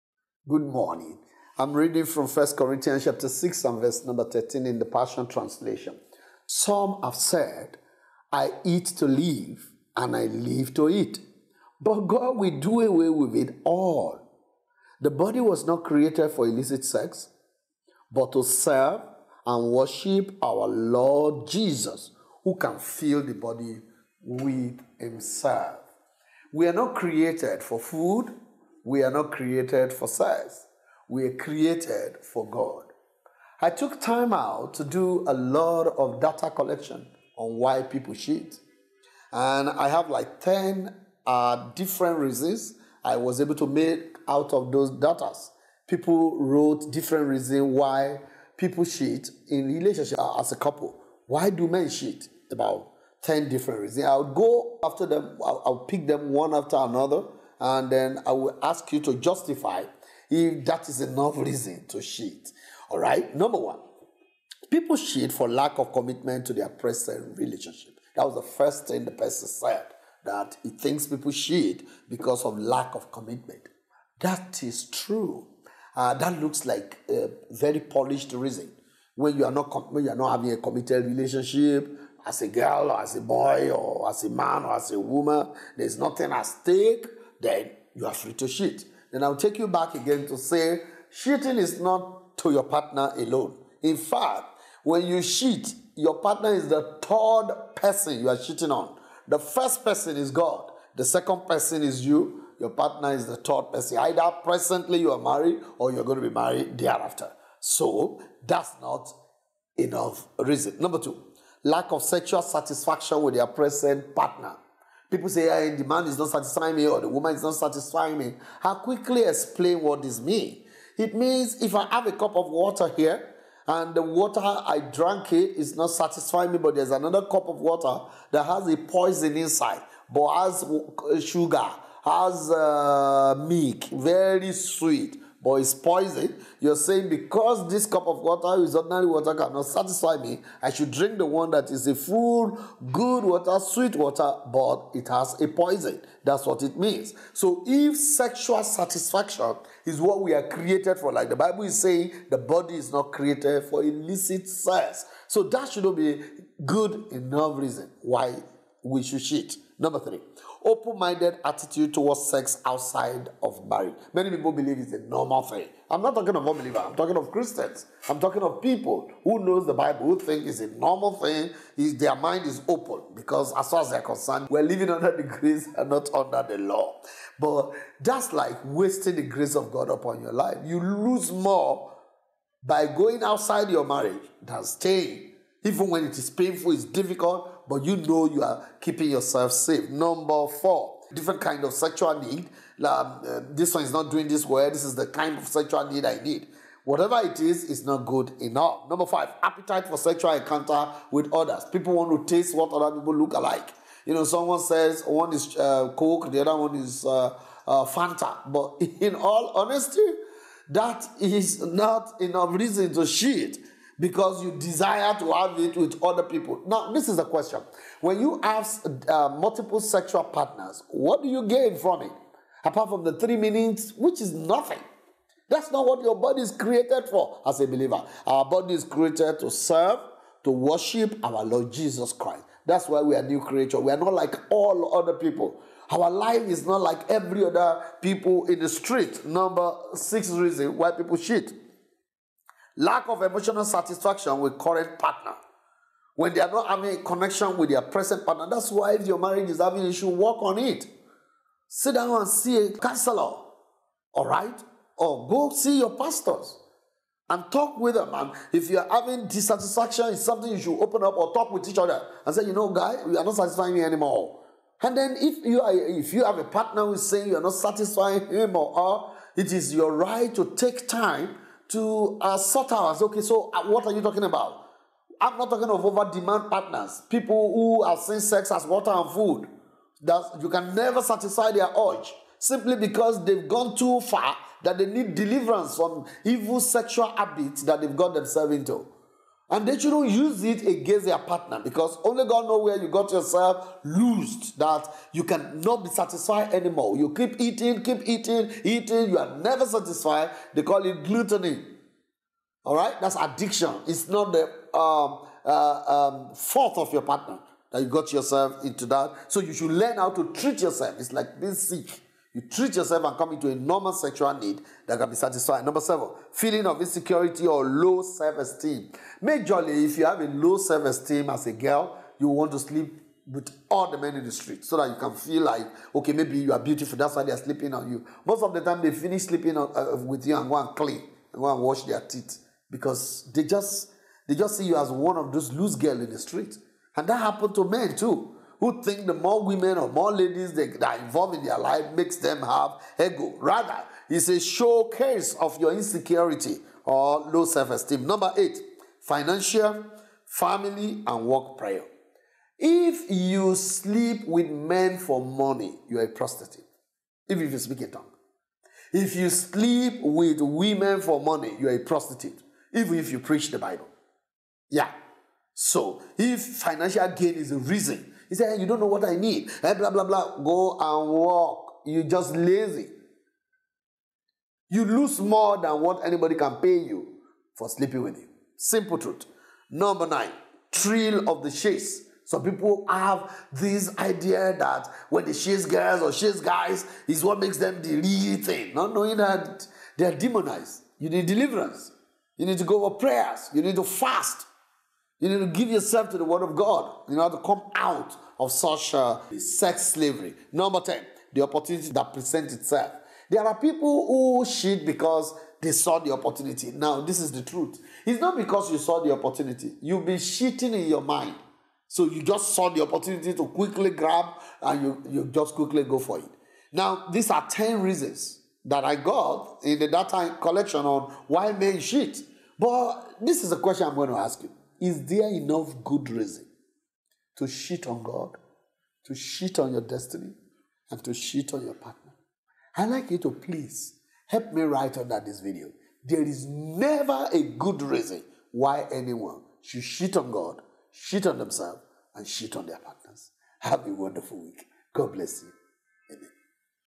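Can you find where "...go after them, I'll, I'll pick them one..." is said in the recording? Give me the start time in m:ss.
0:54.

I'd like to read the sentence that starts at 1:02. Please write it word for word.
All right, number one, people cheat for lack of commitment to their present relationship.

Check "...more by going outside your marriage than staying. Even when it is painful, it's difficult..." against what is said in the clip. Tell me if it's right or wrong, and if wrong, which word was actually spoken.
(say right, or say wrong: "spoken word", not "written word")
right.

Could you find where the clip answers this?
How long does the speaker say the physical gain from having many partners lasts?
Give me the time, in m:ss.
3:43.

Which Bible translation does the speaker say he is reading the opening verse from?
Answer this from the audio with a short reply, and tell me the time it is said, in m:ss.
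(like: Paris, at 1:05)
Passion Translation, at 0:04.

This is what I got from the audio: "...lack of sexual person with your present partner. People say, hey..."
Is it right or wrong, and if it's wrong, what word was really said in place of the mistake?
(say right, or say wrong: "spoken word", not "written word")
wrong: "satisfaction", not "person".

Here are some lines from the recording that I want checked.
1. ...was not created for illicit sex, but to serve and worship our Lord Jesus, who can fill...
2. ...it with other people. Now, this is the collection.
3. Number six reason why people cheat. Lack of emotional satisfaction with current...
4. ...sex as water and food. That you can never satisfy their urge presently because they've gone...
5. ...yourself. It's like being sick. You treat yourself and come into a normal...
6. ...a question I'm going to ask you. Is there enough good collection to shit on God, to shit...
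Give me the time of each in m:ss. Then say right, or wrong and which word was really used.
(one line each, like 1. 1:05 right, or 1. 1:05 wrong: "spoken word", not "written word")
1. 0:15 right
2. 3:35 wrong: "question", not "collection"
3. 3:59 right
4. 4:38 wrong: "simply", not "presently"
5. 5:10 right
6. 7:03 wrong: "reason", not "collection".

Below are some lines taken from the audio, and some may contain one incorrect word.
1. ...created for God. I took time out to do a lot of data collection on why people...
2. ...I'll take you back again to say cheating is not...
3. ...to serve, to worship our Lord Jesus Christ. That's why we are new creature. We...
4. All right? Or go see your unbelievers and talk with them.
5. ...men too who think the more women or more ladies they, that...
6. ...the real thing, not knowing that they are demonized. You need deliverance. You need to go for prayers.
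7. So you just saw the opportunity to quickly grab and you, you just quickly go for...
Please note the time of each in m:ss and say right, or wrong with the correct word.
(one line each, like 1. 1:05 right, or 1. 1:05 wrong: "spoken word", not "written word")
1. 0:31 right
2. 1:29 right
3. 3:49 right
4. 4:14 wrong: "pastors", not "unbelievers"
5. 5:37 right
6. 6:27 right
7. 6:51 right.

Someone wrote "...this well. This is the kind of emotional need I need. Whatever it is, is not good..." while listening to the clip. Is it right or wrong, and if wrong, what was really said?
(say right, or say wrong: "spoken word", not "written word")
wrong: "sexual", not "emotional".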